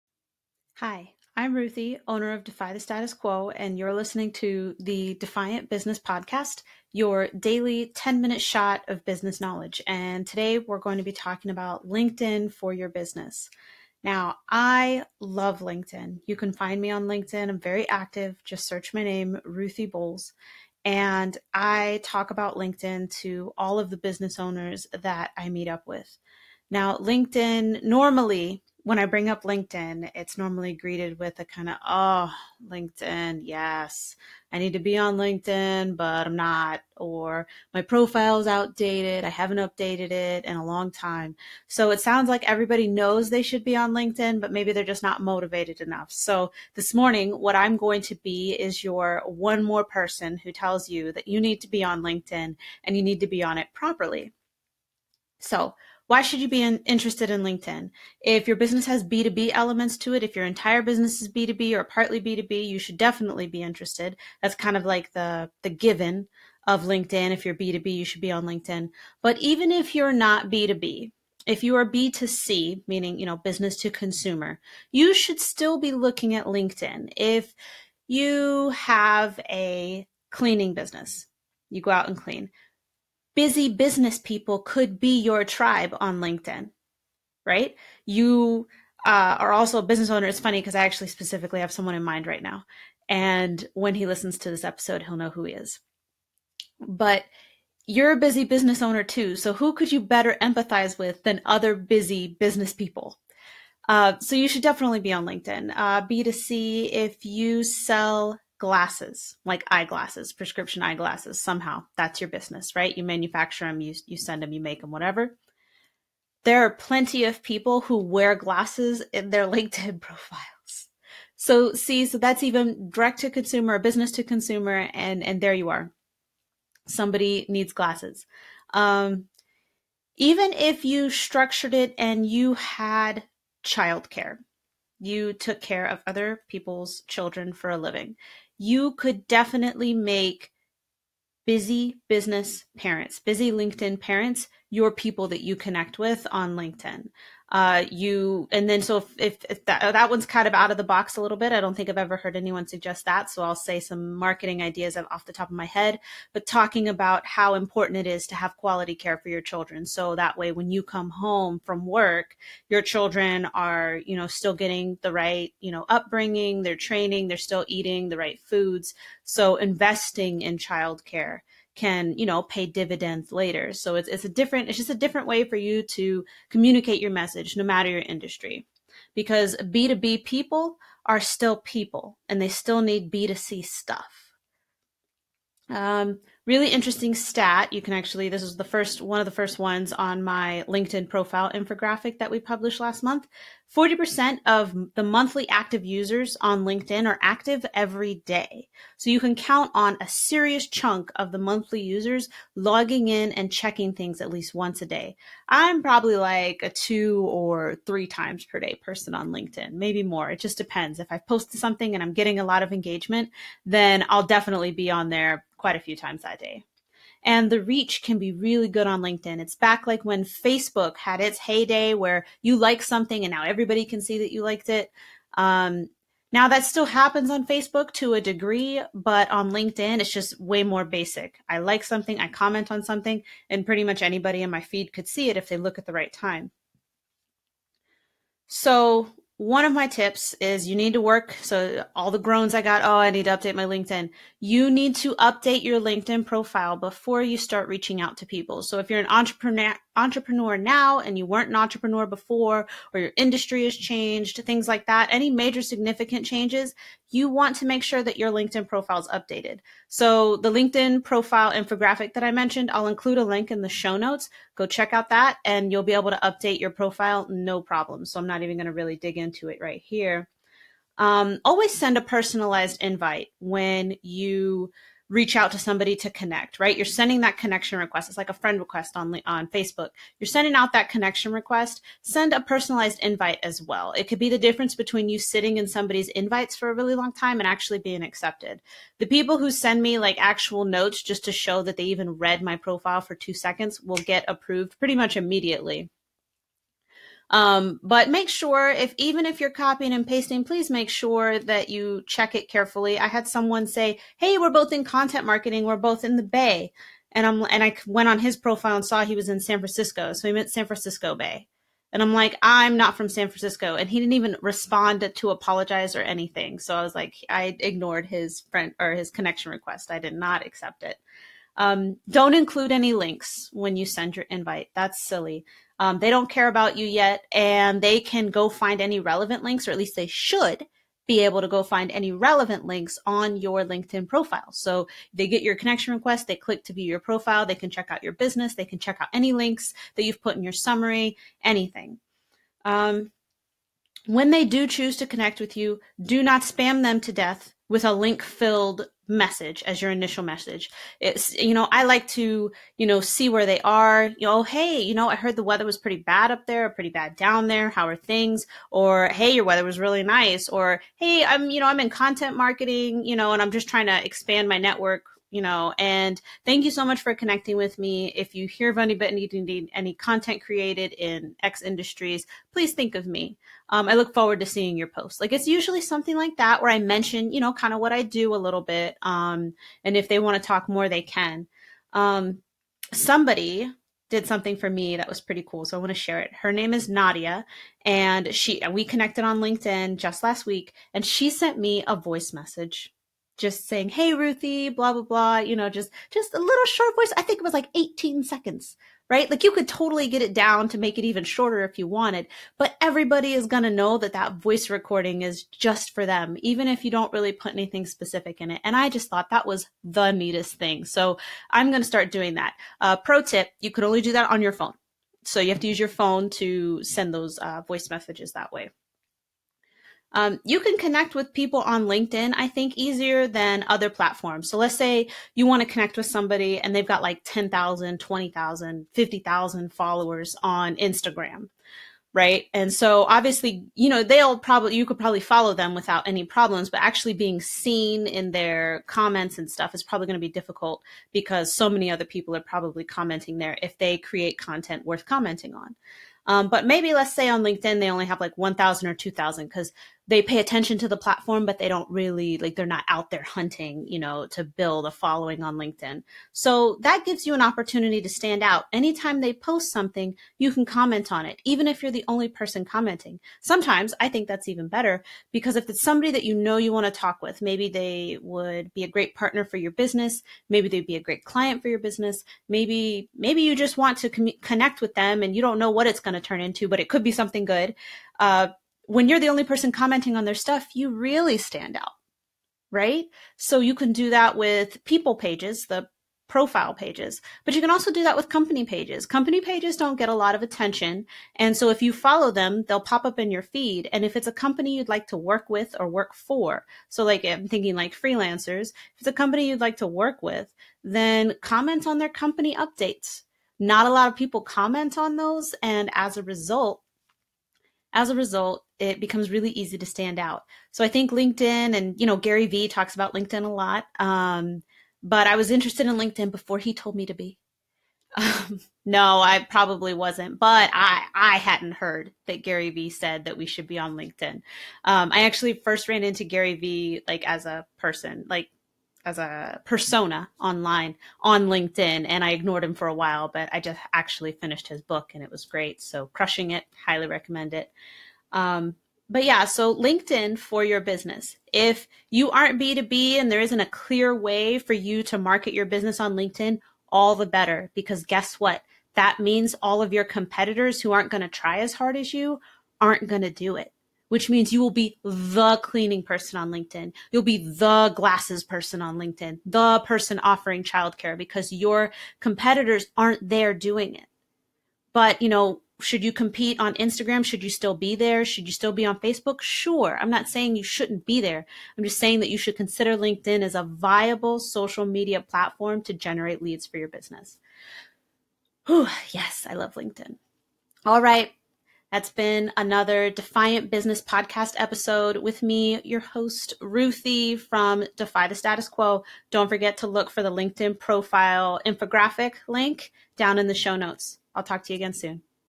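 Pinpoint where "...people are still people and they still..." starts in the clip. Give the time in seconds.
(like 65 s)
180 s.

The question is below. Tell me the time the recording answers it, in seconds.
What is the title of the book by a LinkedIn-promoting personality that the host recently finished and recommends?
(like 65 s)
536 s.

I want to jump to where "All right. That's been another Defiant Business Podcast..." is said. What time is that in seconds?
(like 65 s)
580 s.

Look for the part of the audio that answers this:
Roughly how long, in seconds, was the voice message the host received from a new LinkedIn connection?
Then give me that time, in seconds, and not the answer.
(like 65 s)
397 s.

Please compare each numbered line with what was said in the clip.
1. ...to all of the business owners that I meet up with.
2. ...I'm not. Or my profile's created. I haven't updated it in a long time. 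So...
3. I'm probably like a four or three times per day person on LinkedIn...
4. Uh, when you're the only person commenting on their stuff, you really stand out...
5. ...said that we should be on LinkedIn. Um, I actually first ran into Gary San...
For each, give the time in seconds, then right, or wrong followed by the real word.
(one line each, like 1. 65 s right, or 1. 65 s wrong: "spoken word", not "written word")
1. 23 s right
2. 36 s wrong: "outdated", not "created"
3. 205 s wrong: "two", not "four"
4. 478 s right
5. 522 s wrong: "Vee", not "San".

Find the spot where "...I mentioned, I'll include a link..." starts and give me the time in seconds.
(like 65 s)
262 s.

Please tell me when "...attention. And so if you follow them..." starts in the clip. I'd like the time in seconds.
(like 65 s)
490 s.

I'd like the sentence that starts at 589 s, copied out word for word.
Don't forget to look for the LinkedIn profile infographic link down in the show notes.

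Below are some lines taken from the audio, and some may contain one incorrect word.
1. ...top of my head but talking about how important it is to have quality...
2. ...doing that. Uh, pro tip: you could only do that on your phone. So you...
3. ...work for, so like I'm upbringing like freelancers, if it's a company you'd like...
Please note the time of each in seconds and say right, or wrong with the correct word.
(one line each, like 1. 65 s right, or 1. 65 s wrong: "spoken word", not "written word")
1. 155 s right
2. 412 s right
3. 495 s wrong: "thinking", not "upbringing".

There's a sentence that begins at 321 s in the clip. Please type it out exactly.
Um, don't include any links when you send your invite.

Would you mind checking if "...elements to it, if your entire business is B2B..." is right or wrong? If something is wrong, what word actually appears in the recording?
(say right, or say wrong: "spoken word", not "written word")
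right.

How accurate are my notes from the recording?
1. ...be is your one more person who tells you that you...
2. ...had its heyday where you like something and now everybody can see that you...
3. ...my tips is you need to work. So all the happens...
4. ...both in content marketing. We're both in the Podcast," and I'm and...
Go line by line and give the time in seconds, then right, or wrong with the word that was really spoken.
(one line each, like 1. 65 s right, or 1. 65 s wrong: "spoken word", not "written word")
1. 48 s right
2. 220 s right
3. 239 s wrong: "groans", not "happens"
4. 304 s wrong: "Bay", not "Podcast".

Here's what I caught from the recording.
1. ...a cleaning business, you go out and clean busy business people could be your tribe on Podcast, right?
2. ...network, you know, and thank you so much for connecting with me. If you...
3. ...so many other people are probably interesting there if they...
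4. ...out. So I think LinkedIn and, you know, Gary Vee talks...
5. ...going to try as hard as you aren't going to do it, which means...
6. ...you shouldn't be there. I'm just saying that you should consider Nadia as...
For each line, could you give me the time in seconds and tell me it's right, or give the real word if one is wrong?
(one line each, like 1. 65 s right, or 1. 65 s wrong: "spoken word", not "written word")
1. 79 s wrong: "LinkedIn", not "Podcast"
2. 364 s right
3. 441 s wrong: "commenting", not "interesting"
4. 510 s right
5. 551 s right
6. 570 s wrong: "LinkedIn", not "Nadia".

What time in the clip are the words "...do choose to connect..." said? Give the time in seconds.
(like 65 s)
344 s.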